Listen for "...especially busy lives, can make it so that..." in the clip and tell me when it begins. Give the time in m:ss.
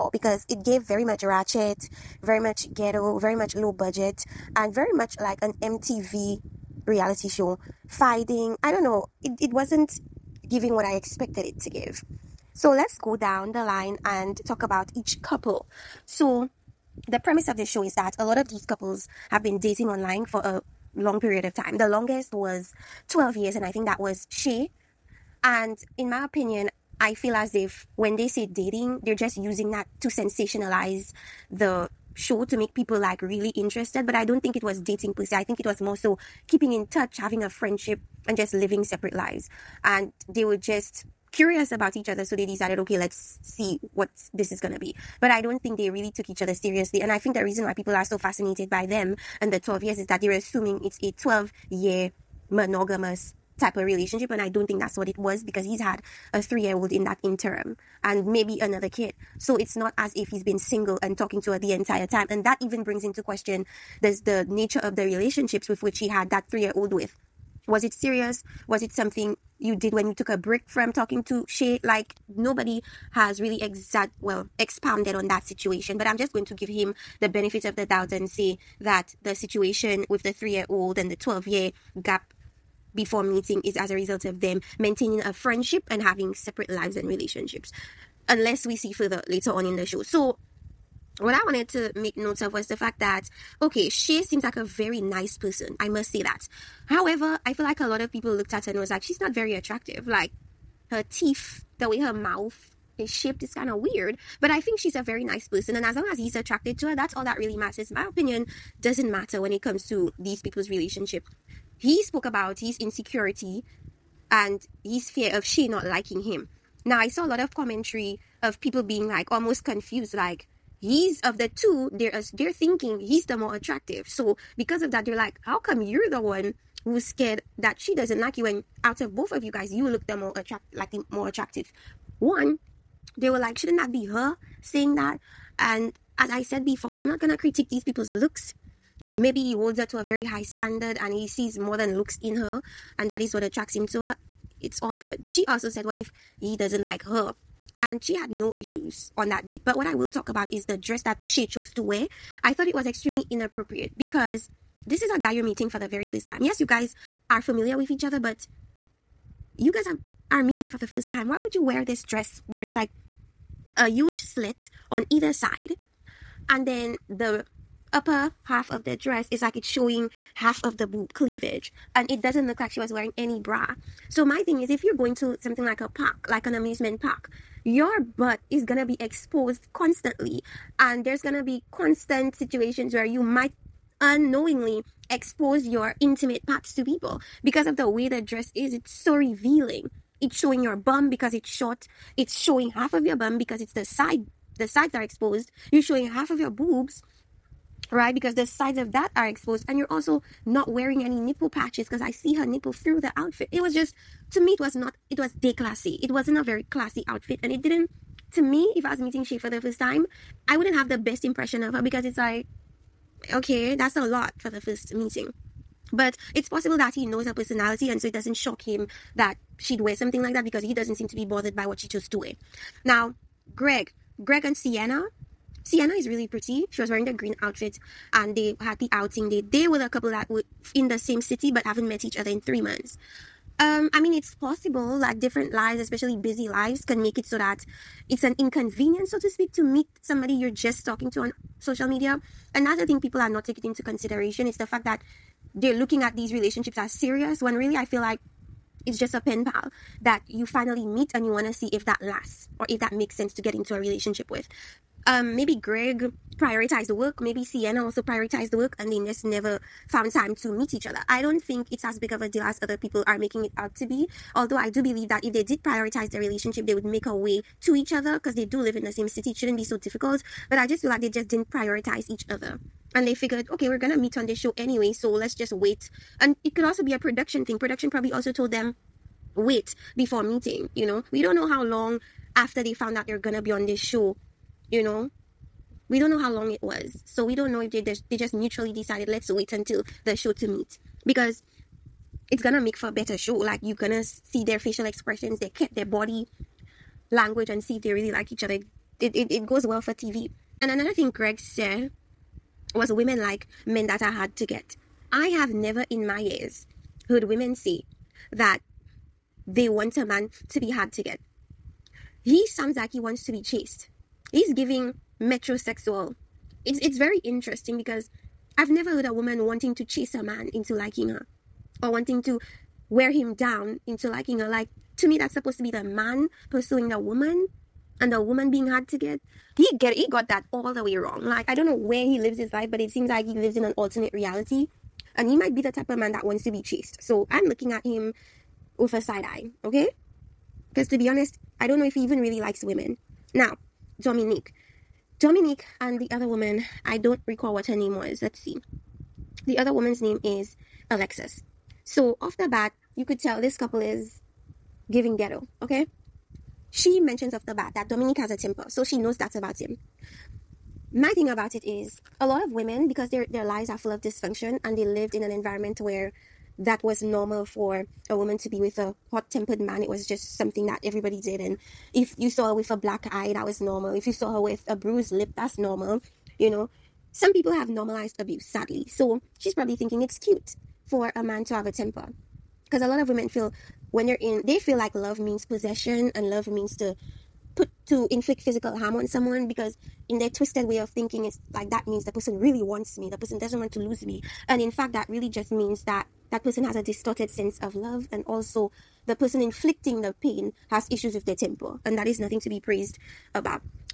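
3:55.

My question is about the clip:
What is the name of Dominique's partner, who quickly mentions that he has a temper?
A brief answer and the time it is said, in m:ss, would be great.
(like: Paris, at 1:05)
Alexis, at 5:50.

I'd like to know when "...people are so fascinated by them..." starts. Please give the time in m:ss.
0:47.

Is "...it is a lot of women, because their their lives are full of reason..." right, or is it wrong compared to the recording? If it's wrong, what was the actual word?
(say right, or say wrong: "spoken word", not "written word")
wrong: "dysfunction", not "reason".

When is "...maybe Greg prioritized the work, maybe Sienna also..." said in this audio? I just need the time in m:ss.
4:15.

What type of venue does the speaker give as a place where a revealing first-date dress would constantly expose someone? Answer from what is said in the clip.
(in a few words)
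amusement park.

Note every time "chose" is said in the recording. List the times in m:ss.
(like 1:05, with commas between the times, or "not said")
2:31, 3:41.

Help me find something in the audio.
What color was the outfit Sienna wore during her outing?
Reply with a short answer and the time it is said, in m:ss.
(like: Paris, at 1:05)
green, at 3:47.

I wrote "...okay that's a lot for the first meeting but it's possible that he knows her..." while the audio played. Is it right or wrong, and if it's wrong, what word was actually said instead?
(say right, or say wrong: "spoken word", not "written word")
right.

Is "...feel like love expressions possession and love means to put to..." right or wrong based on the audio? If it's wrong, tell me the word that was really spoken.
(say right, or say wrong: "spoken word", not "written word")
wrong: "means", not "expressions".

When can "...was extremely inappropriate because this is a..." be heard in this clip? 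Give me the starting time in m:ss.
2:32.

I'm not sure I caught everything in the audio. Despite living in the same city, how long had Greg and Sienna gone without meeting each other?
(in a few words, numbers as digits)
three months.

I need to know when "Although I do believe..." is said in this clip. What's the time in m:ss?
4:24.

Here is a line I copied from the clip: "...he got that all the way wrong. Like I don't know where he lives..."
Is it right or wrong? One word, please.
right.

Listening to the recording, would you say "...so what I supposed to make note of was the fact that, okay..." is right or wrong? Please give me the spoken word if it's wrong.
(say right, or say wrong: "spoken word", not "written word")
wrong: "wanted", not "supposed".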